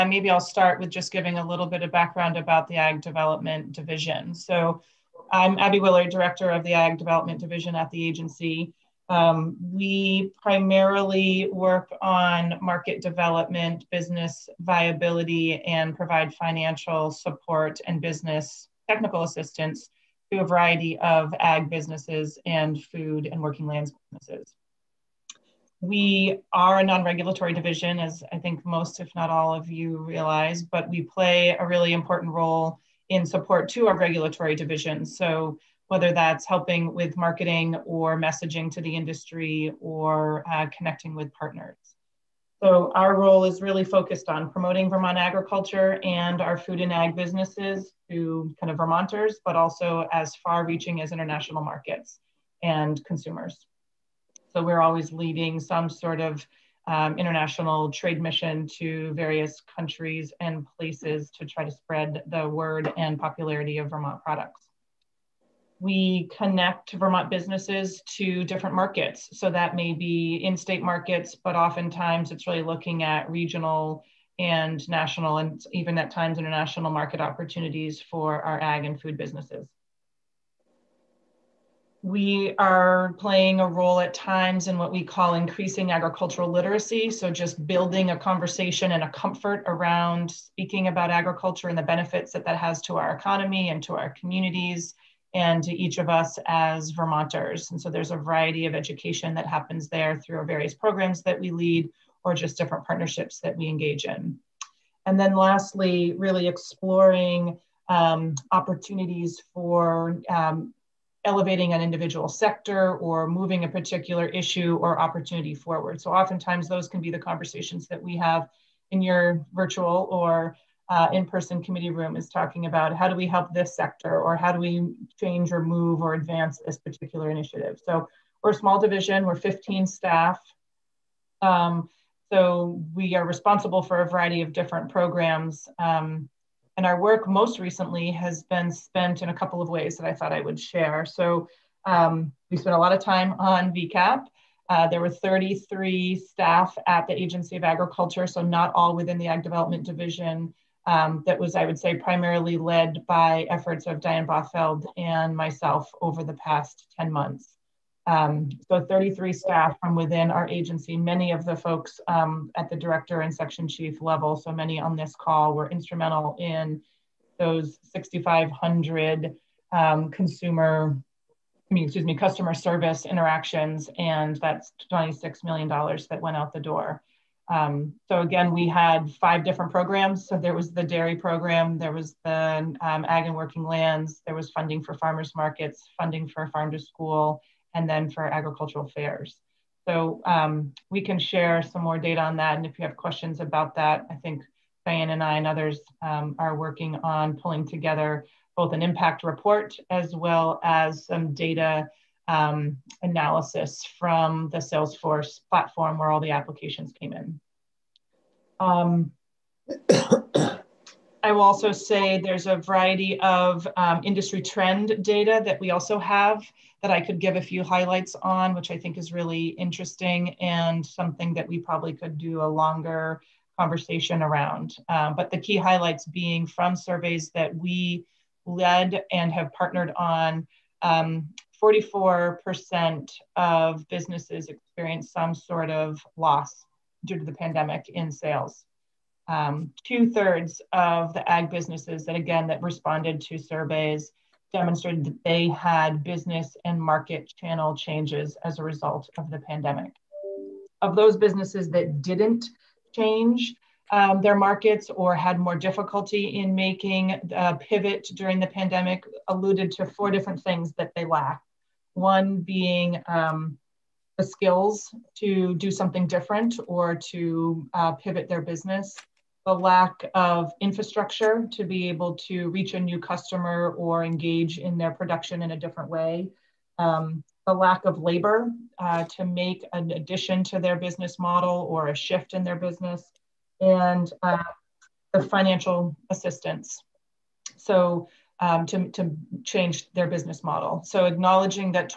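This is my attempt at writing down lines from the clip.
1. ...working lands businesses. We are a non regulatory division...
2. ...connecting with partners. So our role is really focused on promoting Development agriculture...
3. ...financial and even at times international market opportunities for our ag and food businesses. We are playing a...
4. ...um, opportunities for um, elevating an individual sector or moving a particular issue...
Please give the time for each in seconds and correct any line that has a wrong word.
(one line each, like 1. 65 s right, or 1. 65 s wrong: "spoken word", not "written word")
1. 23 s right
2. 40 s wrong: "Vermont", not "Development"
3. 74 s wrong: "national", not "financial"
4. 107 s right.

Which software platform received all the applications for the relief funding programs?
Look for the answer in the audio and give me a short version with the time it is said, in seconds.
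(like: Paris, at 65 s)
Salesforce, at 204 s.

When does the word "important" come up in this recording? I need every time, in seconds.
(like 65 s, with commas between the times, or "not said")
31 s.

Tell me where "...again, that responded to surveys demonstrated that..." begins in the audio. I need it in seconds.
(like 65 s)
242 s.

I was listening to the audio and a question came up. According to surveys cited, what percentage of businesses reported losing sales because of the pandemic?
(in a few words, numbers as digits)
44%.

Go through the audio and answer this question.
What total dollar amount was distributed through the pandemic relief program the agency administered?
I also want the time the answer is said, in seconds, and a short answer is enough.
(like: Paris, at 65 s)
$26 million, at 174 s.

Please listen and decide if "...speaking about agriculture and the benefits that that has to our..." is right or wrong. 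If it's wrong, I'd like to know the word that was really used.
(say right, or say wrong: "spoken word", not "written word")
right.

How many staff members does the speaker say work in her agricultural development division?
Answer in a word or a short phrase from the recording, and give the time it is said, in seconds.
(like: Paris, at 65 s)
15, at 129 s.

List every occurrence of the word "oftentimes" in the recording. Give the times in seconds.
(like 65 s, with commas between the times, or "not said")
71 s, 116 s.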